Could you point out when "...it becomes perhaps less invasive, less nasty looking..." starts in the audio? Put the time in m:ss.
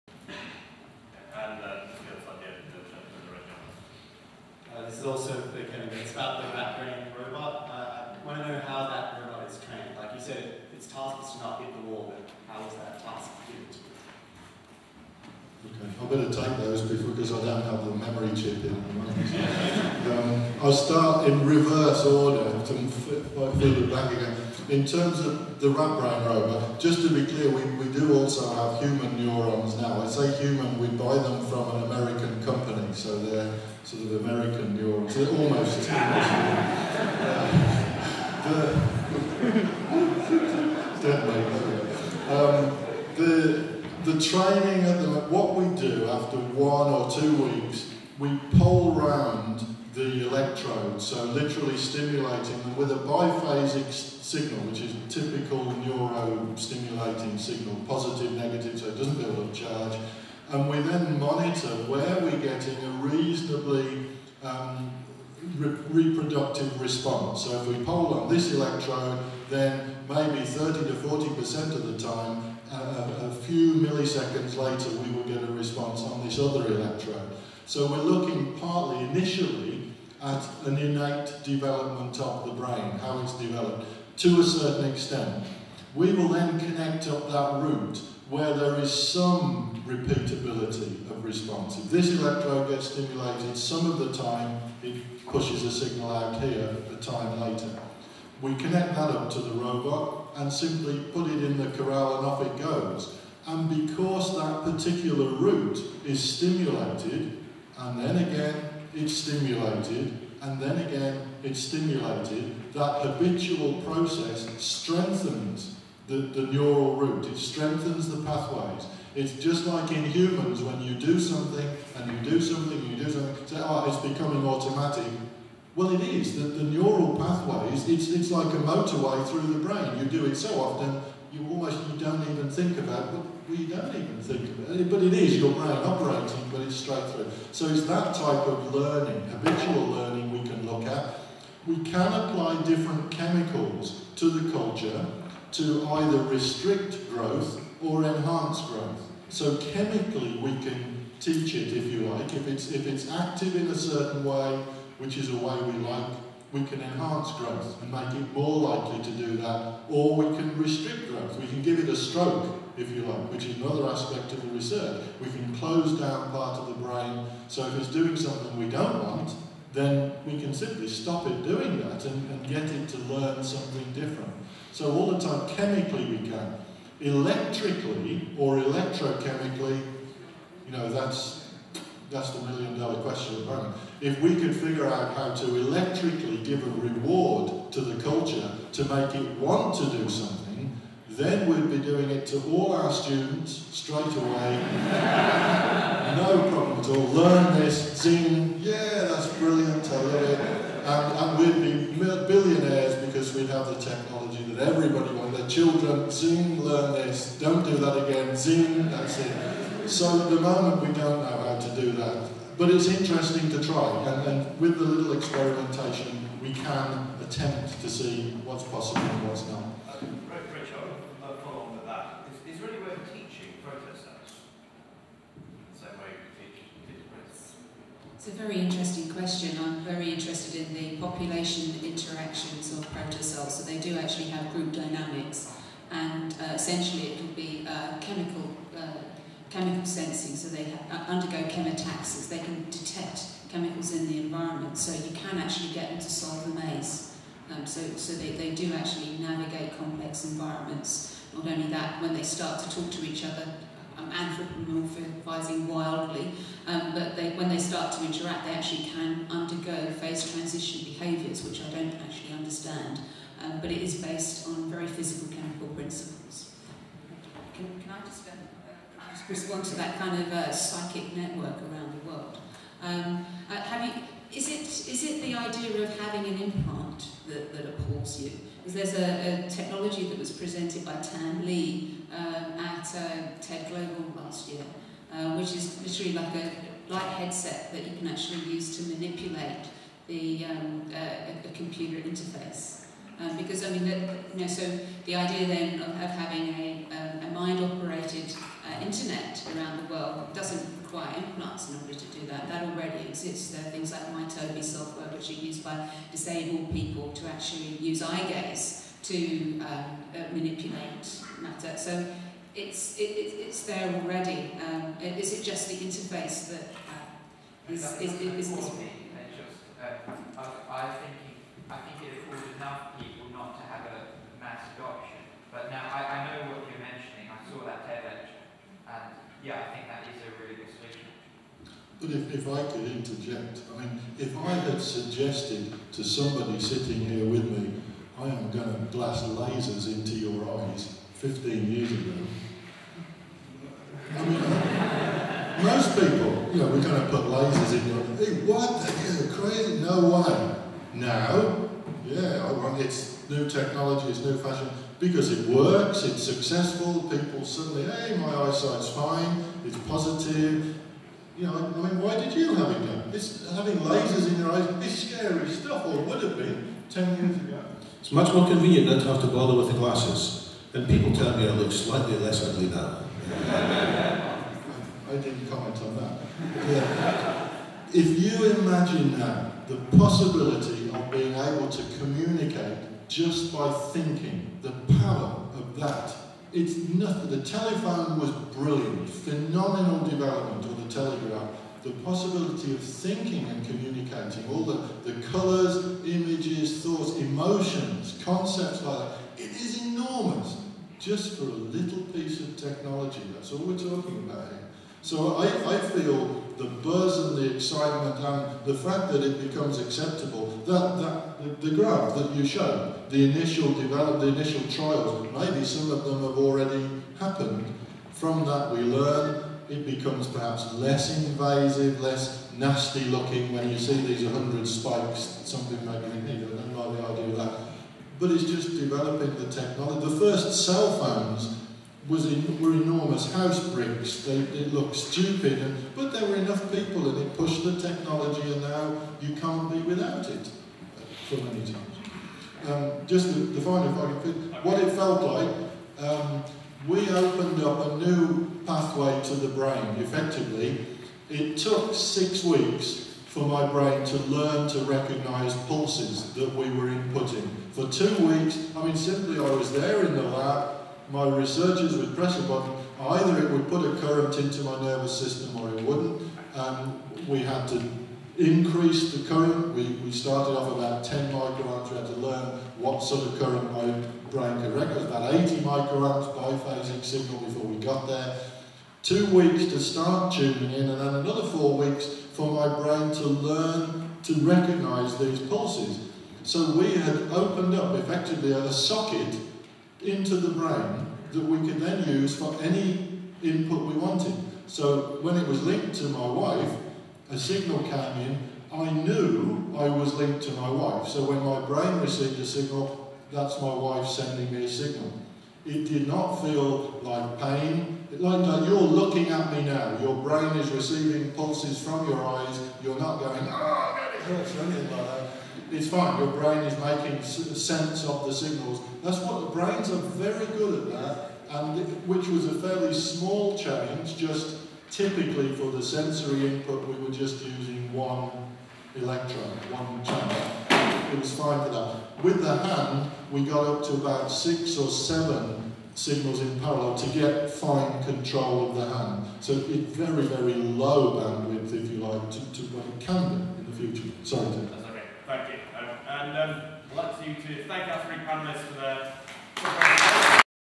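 6:59.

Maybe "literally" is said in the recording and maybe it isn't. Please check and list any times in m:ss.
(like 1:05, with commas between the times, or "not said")
0:51, 4:45.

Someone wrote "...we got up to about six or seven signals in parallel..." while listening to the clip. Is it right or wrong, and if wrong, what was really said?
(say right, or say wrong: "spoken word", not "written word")
right.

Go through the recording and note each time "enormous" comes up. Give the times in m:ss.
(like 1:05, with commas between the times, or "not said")
6:39, 7:12.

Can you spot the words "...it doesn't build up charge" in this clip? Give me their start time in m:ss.
0:58.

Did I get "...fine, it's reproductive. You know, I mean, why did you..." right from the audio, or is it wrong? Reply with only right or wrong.
wrong.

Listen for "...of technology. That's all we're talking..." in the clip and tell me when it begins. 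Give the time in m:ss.
6:42.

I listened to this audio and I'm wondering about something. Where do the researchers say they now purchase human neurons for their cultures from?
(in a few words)
An American company.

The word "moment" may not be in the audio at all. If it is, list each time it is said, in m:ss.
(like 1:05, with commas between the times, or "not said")
3:03, 3:30.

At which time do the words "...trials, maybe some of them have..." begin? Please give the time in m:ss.
6:54.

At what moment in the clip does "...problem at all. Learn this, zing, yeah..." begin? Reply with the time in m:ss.
3:16.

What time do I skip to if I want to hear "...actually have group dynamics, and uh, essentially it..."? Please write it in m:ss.
3:53.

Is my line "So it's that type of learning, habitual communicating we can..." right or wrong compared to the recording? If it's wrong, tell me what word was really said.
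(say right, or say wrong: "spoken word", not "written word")
wrong: "learning", not "communicating".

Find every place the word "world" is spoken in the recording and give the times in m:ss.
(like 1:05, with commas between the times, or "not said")
4:32, 4:59.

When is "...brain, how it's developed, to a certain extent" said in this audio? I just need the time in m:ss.
1:22.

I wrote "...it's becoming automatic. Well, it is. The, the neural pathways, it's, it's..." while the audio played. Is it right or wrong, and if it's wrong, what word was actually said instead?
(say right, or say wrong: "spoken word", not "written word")
right.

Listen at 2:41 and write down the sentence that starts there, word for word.
We can give it a stroke if you like, which is another aspect of the research.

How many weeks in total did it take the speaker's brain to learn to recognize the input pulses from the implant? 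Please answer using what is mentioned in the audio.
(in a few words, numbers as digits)
6 weeks.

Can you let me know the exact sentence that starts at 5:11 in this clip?
So it's, it, it's there already.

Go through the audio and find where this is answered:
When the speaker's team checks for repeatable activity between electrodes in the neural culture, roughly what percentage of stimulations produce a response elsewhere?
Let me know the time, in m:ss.
1:10.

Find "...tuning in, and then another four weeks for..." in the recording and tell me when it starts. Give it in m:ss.
8:00.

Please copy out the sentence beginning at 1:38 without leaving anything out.
We connect that up to the robot and simply put it in the corral and off it goes.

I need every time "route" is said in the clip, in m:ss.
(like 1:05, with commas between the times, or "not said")
1:27, 1:45, 1:56.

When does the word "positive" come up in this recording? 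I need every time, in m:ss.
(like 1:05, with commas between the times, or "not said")
0:57, 5:59.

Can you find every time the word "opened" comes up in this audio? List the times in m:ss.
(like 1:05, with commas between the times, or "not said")
7:27, 8:07.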